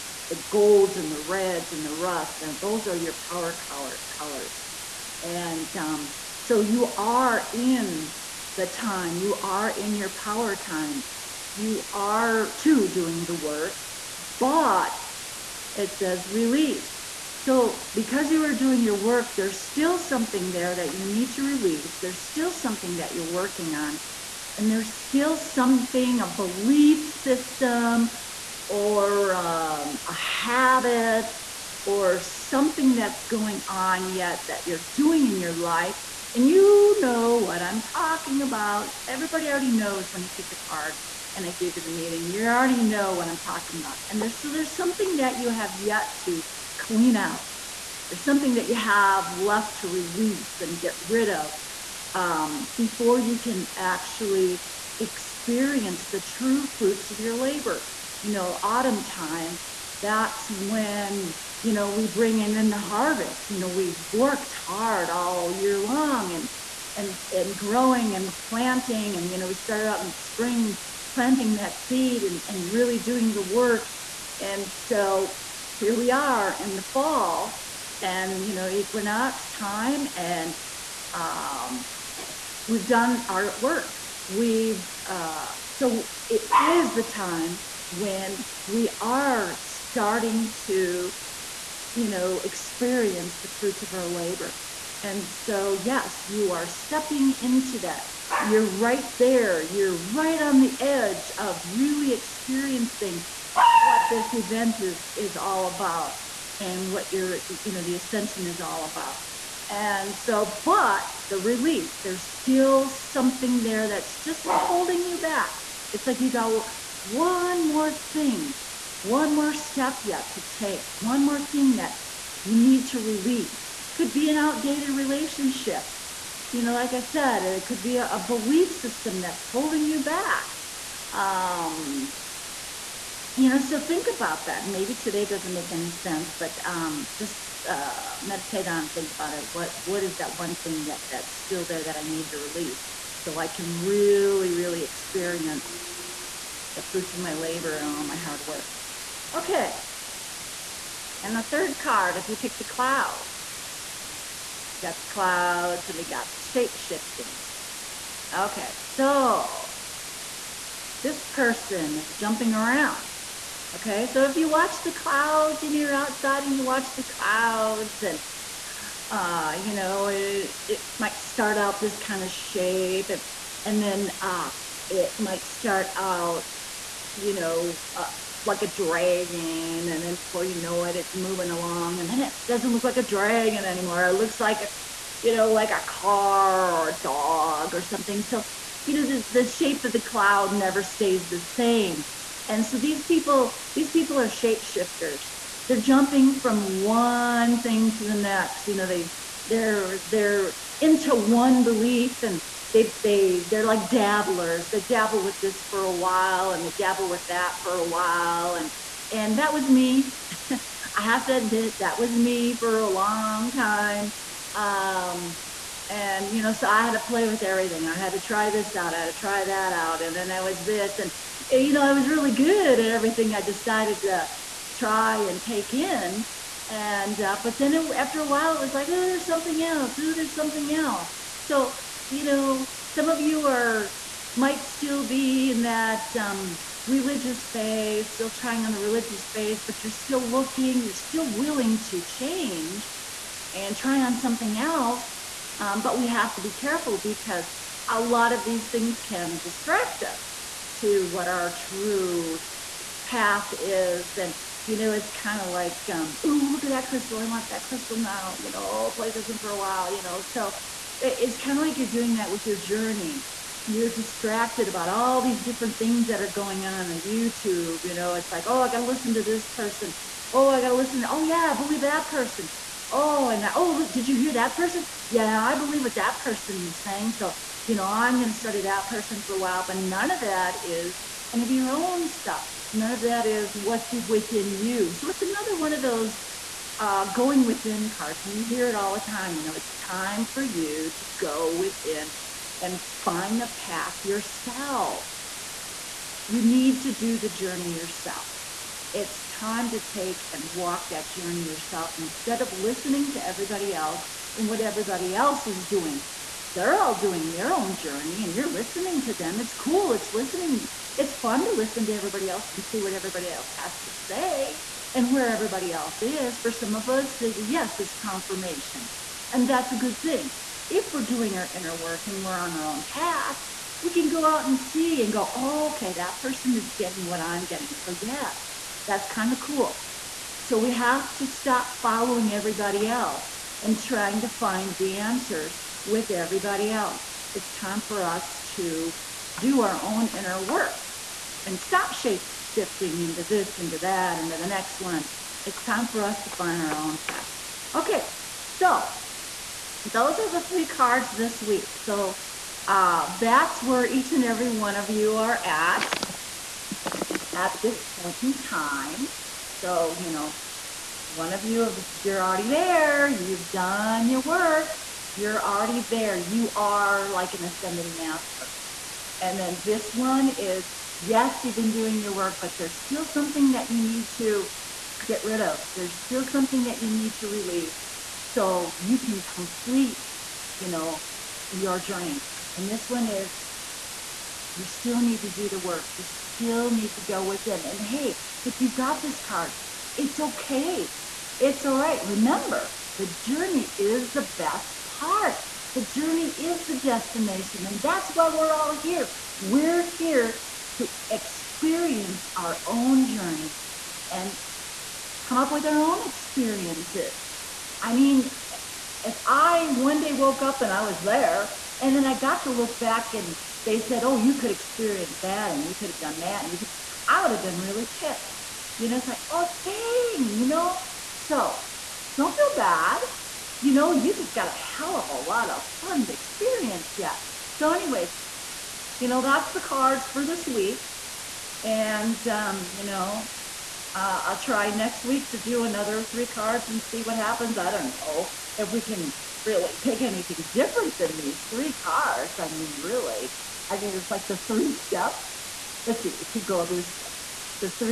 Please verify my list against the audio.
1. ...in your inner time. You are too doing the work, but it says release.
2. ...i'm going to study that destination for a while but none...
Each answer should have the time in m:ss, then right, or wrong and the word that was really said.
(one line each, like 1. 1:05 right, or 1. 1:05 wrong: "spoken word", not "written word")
1. 0:09 wrong: "power", not "inner"
2. 4:37 wrong: "person", not "destination".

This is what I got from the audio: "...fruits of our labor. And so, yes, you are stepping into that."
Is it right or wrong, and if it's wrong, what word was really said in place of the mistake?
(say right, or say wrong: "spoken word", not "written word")
right.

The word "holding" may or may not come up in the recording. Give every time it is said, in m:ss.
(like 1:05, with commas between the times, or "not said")
1:54, 2:09.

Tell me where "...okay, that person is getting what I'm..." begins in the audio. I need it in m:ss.
5:25.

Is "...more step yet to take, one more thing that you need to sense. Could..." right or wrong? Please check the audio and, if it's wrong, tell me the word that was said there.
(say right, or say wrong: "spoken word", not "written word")
wrong: "release", not "sense".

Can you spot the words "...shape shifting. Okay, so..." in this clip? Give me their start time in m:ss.
2:36.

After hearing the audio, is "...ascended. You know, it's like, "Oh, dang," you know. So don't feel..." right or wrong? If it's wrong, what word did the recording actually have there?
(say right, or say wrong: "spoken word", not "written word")
wrong: "pissed", not "ascended".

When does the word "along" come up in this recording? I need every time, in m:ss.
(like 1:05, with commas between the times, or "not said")
3:01.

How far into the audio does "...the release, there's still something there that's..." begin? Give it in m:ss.
1:51.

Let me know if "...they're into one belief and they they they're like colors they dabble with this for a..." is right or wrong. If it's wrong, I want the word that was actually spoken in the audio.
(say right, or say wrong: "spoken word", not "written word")
wrong: "dabblers", not "colors".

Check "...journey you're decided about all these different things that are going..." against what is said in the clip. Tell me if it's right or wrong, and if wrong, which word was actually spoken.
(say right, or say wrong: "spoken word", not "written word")
wrong: "distracted", not "decided".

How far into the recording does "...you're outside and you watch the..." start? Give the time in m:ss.
2:45.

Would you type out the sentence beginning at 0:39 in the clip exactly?
Everybody already knows when you pick the card and I gave you the meeting.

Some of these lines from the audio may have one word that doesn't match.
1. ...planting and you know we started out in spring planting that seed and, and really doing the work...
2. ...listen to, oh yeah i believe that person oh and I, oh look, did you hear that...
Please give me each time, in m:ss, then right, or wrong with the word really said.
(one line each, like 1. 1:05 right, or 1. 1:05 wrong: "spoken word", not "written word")
1. 1:08 right
2. 4:30 right.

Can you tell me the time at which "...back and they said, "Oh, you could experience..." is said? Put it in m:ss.
6:52.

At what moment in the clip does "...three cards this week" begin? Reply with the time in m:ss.
5:50.